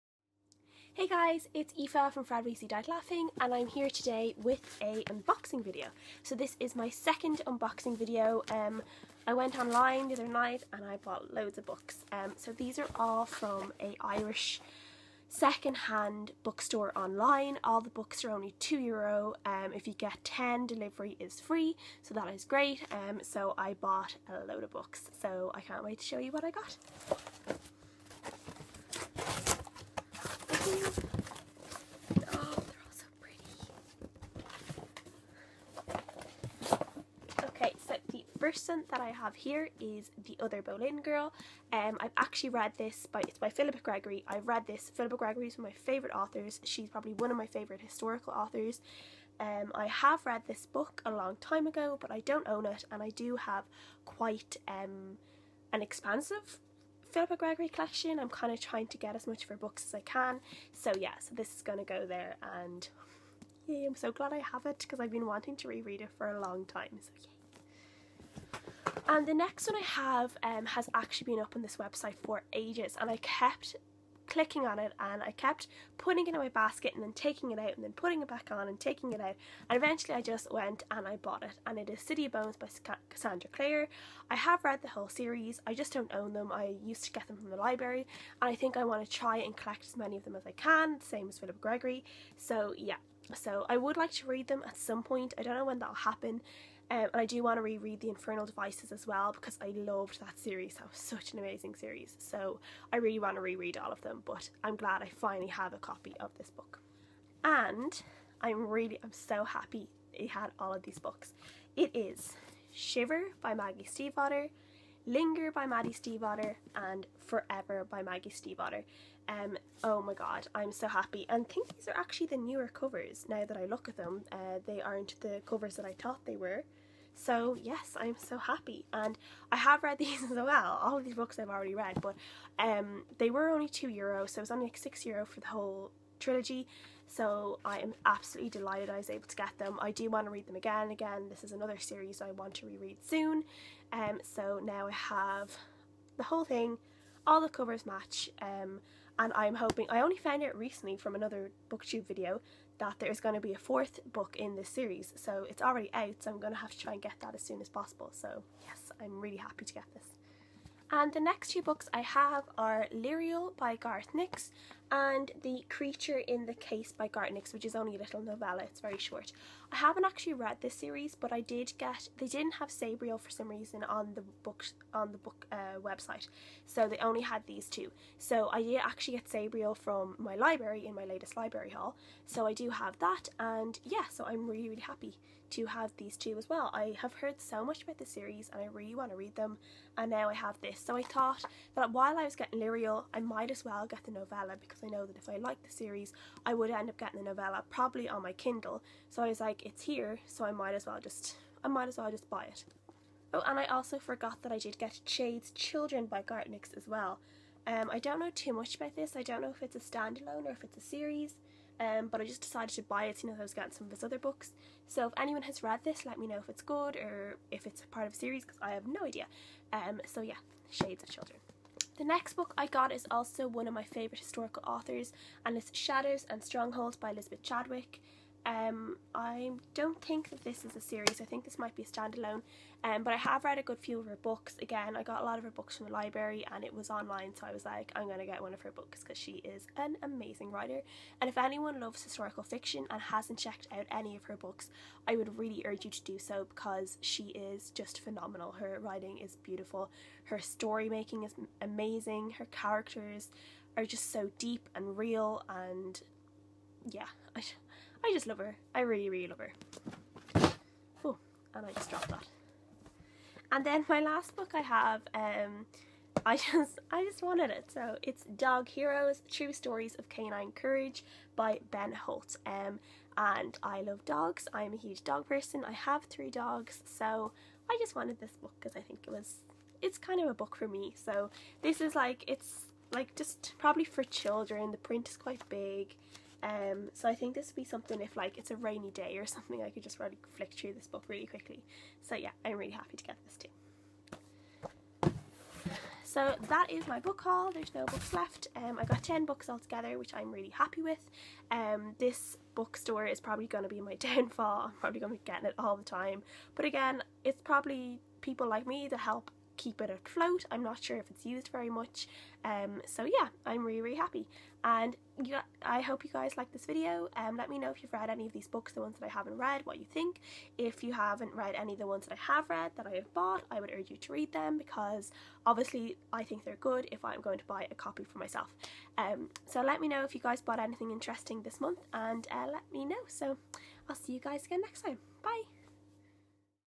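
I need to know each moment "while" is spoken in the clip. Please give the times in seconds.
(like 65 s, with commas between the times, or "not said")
191 s.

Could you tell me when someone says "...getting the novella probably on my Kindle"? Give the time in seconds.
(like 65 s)
196 s.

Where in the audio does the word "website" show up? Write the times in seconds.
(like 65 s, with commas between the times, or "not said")
71 s, 175 s.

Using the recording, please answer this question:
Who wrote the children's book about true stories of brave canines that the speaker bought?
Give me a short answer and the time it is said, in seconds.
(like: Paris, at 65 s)
Ben Holt, at 271 s.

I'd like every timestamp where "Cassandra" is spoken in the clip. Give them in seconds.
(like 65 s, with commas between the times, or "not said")
83 s.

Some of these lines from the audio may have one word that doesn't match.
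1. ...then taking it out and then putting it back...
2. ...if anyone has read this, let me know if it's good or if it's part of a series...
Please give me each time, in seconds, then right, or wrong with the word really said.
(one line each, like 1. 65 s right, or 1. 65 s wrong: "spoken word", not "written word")
1. 77 s right
2. 215 s right.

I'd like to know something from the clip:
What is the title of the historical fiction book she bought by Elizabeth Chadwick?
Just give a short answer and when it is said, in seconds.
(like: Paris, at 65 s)
Shadows and Strongholds, at 225 s.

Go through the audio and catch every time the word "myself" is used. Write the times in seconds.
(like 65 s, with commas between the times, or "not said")
328 s.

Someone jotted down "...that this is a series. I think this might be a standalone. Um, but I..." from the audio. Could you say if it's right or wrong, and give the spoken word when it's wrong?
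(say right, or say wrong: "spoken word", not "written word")
right.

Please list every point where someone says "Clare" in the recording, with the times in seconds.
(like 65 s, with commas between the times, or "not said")
83 s.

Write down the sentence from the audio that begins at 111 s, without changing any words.
It is Shiver by Maggie Stiefvater, Linger by Maggie Stiefvater, and Forever by Maggie Stiefvater.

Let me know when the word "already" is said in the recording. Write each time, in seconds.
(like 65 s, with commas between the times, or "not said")
131 s, 155 s.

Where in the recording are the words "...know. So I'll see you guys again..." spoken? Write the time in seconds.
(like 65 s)
332 s.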